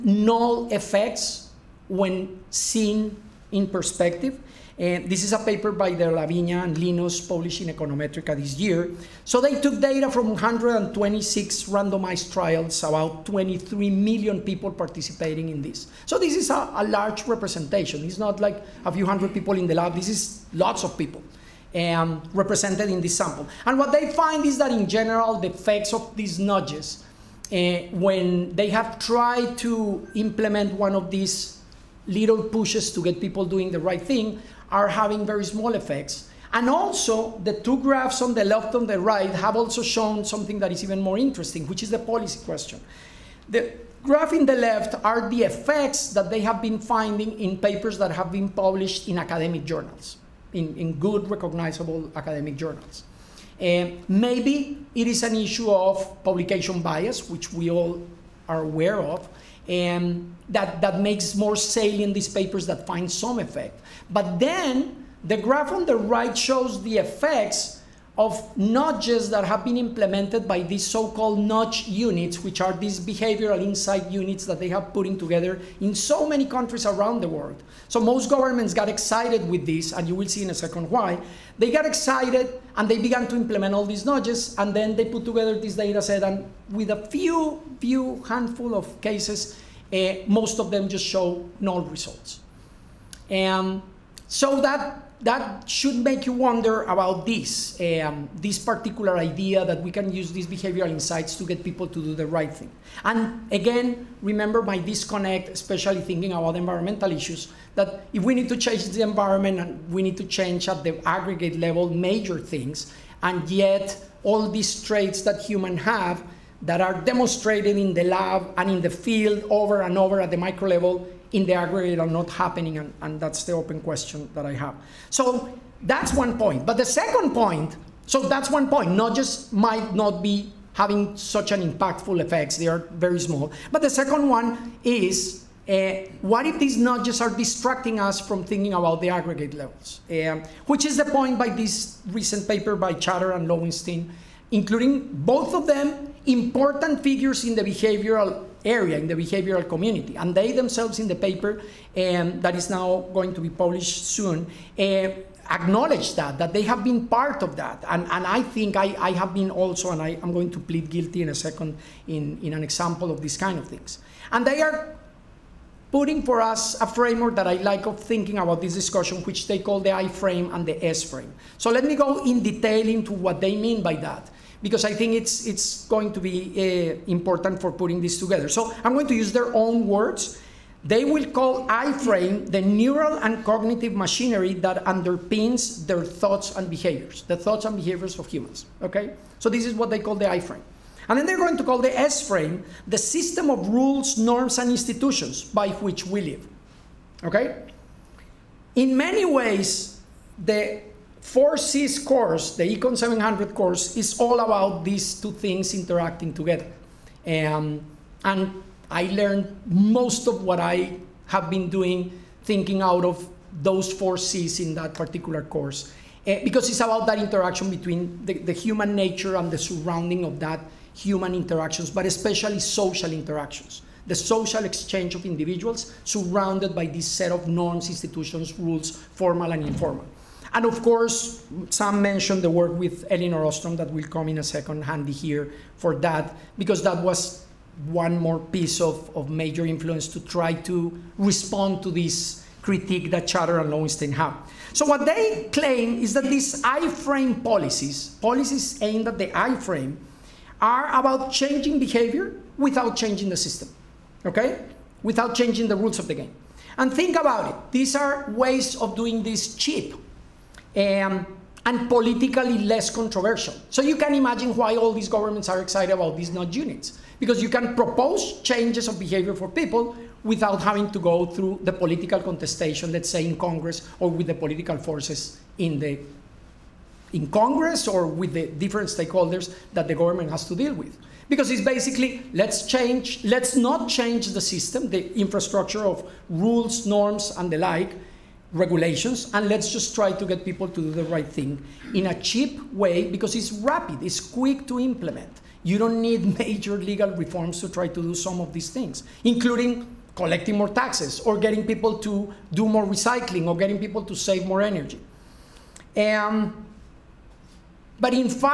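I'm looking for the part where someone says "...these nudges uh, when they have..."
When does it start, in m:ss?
0:26.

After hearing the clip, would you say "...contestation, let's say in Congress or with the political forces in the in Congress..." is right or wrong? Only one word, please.
right.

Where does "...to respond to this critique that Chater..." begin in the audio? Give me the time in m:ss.
4:00.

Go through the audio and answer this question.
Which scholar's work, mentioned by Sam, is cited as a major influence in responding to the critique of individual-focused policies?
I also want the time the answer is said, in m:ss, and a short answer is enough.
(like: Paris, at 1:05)
Elinor Ostrom, at 3:53.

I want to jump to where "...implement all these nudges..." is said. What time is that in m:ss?
1:23.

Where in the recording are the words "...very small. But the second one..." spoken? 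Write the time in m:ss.
2:12.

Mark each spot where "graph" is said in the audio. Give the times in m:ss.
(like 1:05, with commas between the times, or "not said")
0:37, 0:44, 1:05.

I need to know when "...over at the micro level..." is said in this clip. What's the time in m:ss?
1:59.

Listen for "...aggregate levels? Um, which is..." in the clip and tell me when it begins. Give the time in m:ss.
2:19.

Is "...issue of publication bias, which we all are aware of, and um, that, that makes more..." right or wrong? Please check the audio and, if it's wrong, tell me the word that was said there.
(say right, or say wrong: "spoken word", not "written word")
right.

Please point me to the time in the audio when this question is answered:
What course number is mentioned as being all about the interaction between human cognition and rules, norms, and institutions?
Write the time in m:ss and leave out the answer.
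3:22.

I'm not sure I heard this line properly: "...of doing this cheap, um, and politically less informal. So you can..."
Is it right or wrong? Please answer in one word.
wrong.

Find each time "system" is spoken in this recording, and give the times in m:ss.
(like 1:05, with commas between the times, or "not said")
3:12, 4:13, 4:44.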